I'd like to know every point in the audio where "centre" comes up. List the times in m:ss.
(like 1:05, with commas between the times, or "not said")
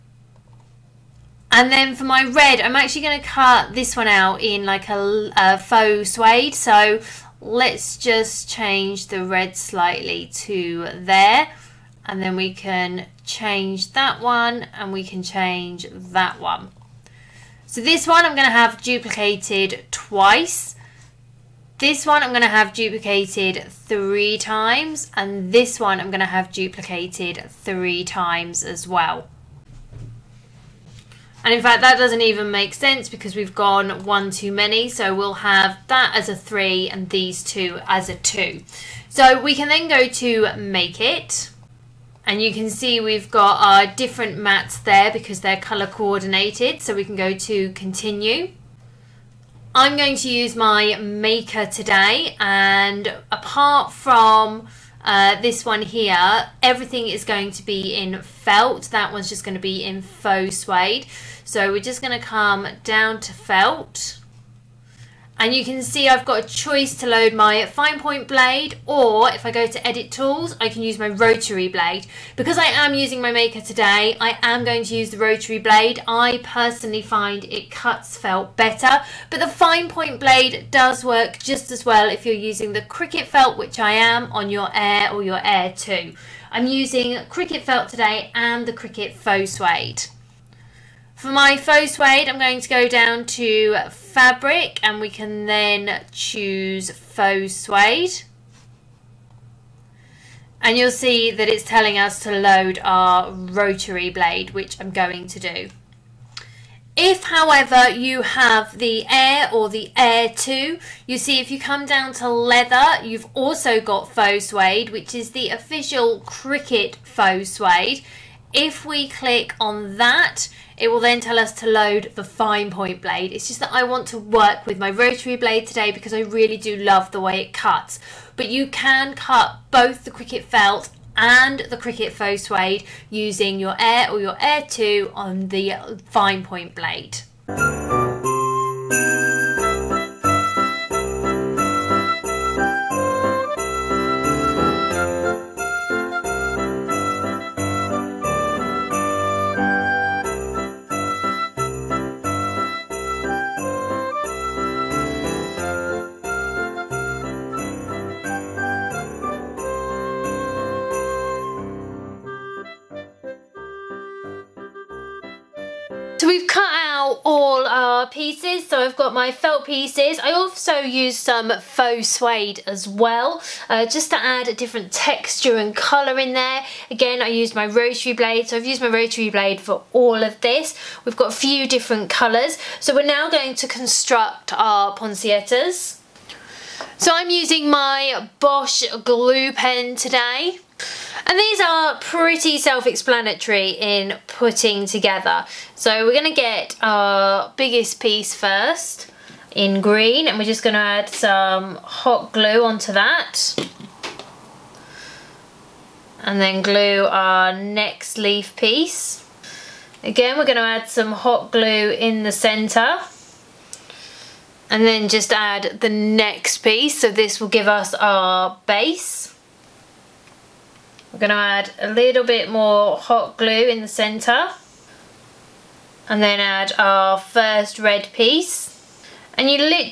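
3:32, 3:43.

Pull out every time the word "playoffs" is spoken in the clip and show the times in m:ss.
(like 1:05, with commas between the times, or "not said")
not said.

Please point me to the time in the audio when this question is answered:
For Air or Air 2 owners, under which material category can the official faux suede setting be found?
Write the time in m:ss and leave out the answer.
1:52.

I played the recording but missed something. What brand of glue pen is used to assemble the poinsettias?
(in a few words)
Bosch.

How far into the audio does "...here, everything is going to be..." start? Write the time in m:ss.
0:55.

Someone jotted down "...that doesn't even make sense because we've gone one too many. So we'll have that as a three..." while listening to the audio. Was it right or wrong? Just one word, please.
right.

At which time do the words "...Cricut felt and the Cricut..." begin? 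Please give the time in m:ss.
2:10.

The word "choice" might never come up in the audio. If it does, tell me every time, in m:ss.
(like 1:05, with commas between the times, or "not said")
1:06.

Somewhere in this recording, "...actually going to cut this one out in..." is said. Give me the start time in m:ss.
0:02.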